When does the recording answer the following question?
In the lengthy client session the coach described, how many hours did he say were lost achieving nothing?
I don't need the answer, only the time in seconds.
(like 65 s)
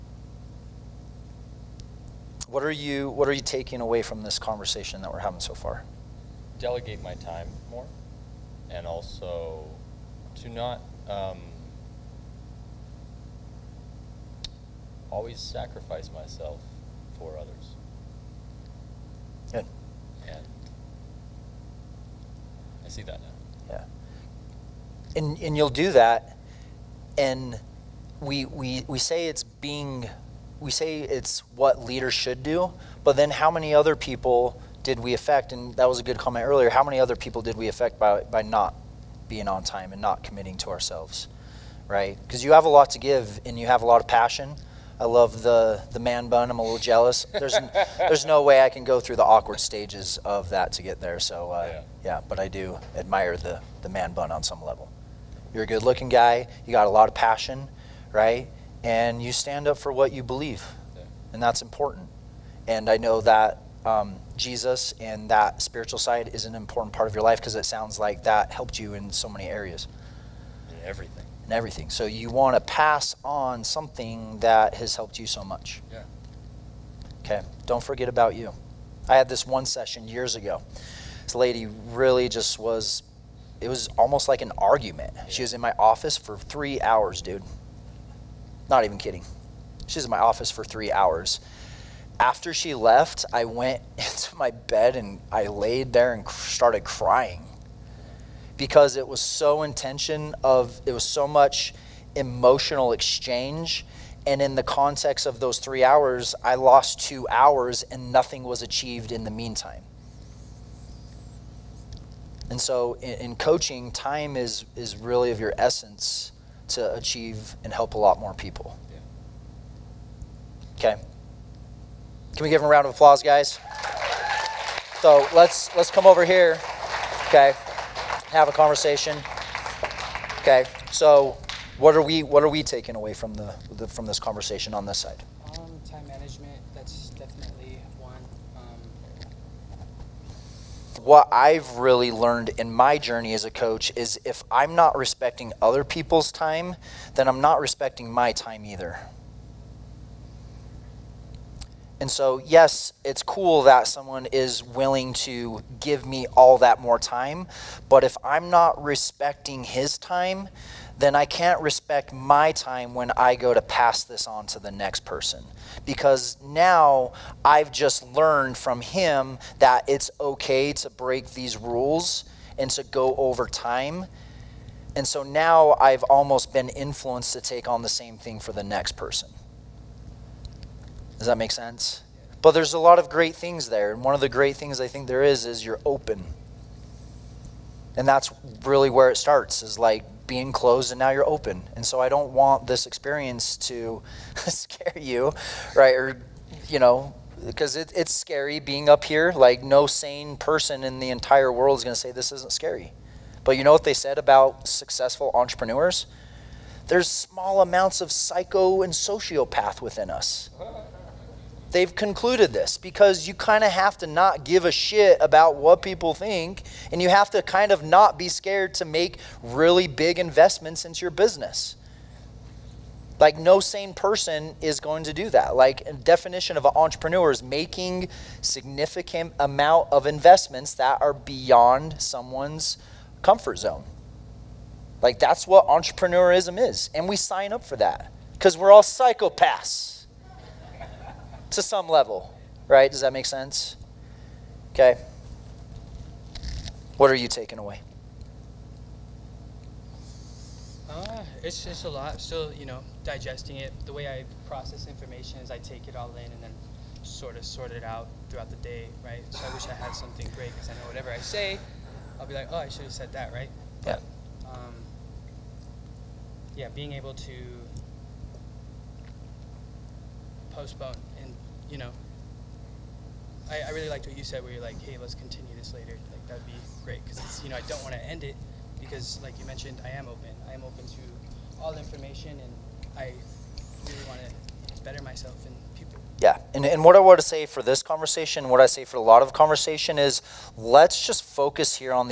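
106 s.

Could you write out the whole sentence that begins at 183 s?
And one of the great things I think there is is you're open.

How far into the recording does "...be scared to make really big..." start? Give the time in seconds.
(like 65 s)
218 s.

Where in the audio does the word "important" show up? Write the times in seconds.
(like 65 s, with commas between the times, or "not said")
61 s, 66 s.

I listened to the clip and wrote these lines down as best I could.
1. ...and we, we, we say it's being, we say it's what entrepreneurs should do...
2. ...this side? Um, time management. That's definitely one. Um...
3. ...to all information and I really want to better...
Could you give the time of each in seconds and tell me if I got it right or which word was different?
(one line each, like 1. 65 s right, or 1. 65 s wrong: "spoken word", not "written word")
1. 27 s wrong: "leaders", not "entrepreneurs"
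2. 134 s right
3. 280 s right.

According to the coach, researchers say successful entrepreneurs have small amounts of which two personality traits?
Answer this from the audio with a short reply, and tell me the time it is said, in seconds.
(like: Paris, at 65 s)
psycho and sociopath, at 208 s.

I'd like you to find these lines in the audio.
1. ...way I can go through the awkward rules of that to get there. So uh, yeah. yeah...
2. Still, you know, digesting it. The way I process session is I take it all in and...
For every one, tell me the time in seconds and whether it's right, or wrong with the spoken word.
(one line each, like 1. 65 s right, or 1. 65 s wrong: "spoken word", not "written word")
1. 48 s wrong: "stages", not "rules"
2. 252 s wrong: "information", not "session".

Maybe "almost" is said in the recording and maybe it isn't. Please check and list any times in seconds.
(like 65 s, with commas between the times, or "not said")
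83 s, 176 s.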